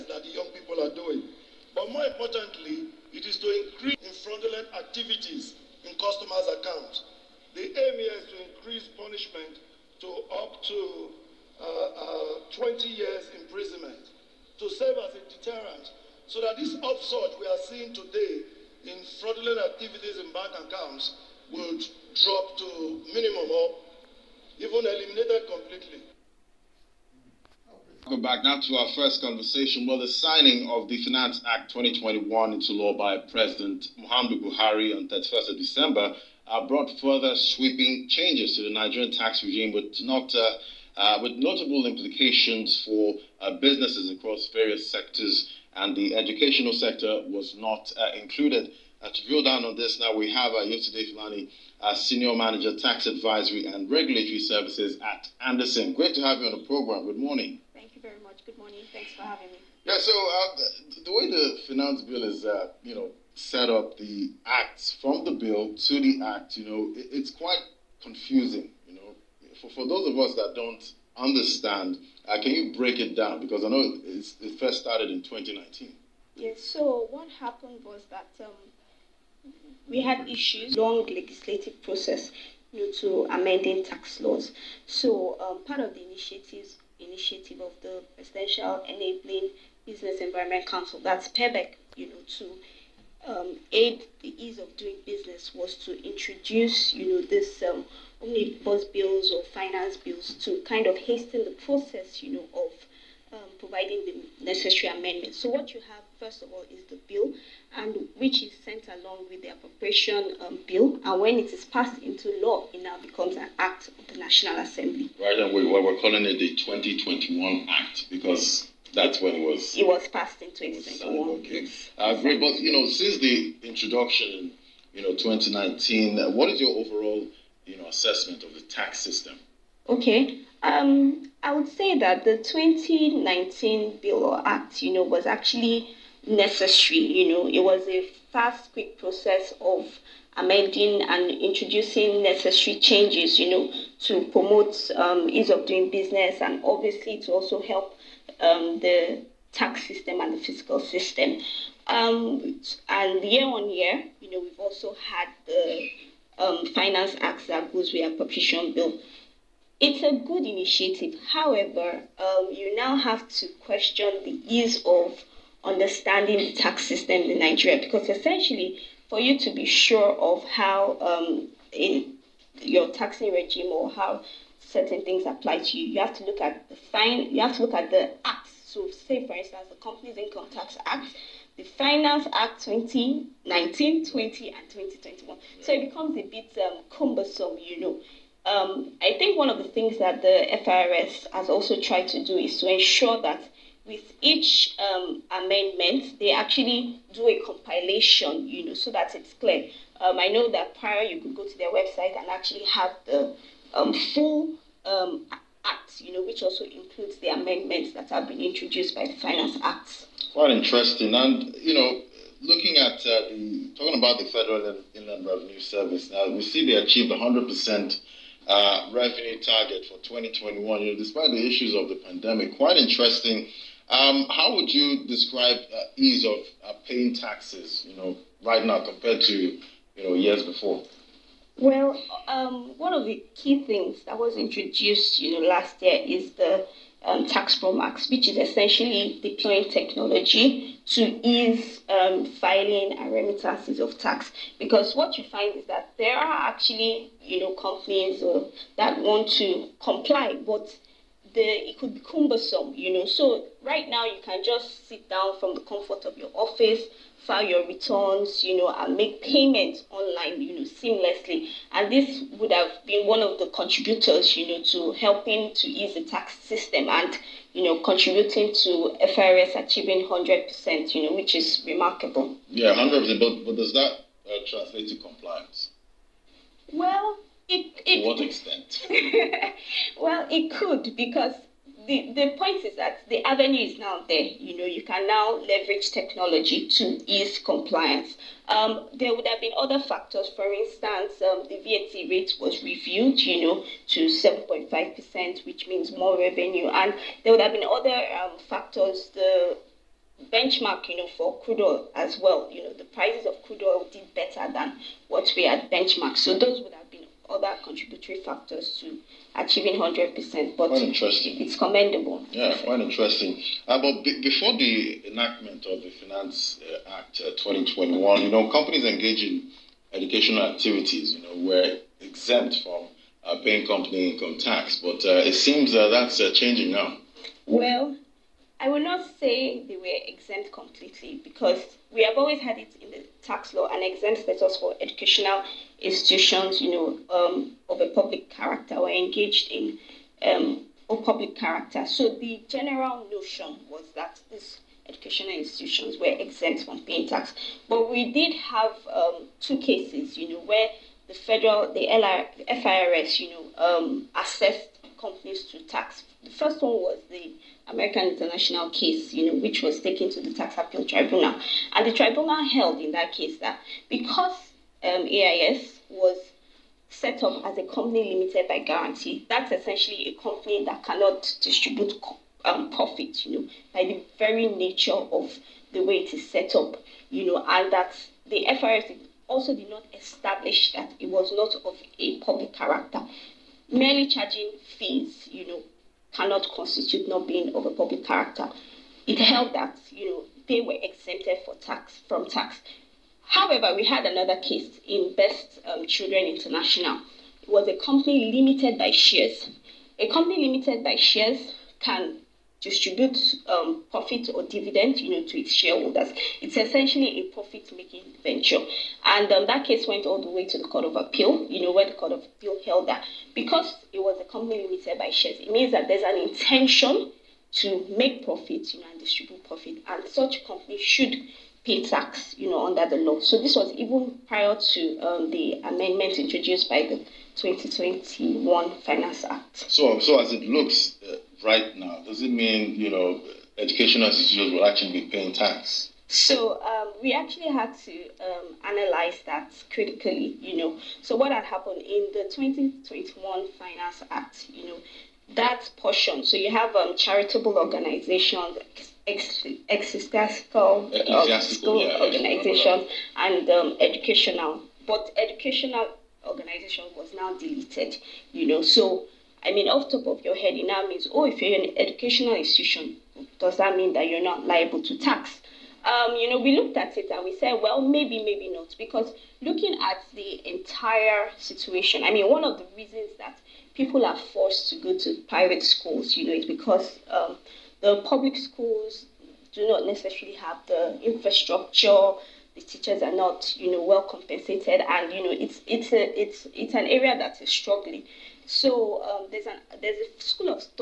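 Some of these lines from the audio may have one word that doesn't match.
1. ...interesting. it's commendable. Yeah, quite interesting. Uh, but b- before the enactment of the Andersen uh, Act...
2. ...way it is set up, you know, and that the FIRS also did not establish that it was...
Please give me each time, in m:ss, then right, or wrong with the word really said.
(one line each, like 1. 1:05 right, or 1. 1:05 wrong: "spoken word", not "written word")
1. 5:10 wrong: "Finance", not "Andersen"
2. 6:15 right.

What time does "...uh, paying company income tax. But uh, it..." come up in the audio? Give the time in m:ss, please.
5:23.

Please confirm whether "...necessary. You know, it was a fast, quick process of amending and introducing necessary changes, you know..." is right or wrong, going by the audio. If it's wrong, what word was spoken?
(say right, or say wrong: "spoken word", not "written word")
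right.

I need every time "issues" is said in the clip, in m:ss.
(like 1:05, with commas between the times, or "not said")
1:20, 3:41.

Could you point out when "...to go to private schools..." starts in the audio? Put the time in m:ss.
7:54.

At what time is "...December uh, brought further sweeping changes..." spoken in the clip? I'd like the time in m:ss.
0:35.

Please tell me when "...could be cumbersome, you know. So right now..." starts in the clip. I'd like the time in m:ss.
4:11.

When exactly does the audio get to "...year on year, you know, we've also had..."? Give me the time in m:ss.
2:33.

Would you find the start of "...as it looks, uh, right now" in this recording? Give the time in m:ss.
7:10.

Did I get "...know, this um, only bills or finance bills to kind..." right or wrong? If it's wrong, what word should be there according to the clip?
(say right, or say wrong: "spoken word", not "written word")
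right.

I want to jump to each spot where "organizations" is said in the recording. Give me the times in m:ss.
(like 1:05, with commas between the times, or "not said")
7:27, 7:32, 7:36.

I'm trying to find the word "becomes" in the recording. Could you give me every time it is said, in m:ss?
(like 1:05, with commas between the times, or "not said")
1:53, 3:05.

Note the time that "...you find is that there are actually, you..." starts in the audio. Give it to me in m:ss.
4:05.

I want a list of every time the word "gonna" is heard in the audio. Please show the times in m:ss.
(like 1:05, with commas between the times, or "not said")
not said.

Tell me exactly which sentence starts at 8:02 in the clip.
The teachers are not, you know, well compensated, and you know, it's it's a it's it's an area that is struggling.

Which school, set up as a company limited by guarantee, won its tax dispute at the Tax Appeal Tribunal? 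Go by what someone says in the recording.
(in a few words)
American International.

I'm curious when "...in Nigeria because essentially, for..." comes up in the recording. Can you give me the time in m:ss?
2:47.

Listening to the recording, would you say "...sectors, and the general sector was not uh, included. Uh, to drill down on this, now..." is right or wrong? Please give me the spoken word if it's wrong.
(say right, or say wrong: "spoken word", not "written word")
wrong: "educational", not "general".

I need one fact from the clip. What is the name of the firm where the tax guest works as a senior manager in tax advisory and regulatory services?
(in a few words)
Andersen.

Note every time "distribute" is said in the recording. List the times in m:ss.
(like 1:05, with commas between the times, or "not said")
6:11, 6:42, 6:58.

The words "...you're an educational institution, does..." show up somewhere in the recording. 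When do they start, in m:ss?
7:41.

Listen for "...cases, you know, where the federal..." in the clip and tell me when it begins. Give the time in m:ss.
5:49.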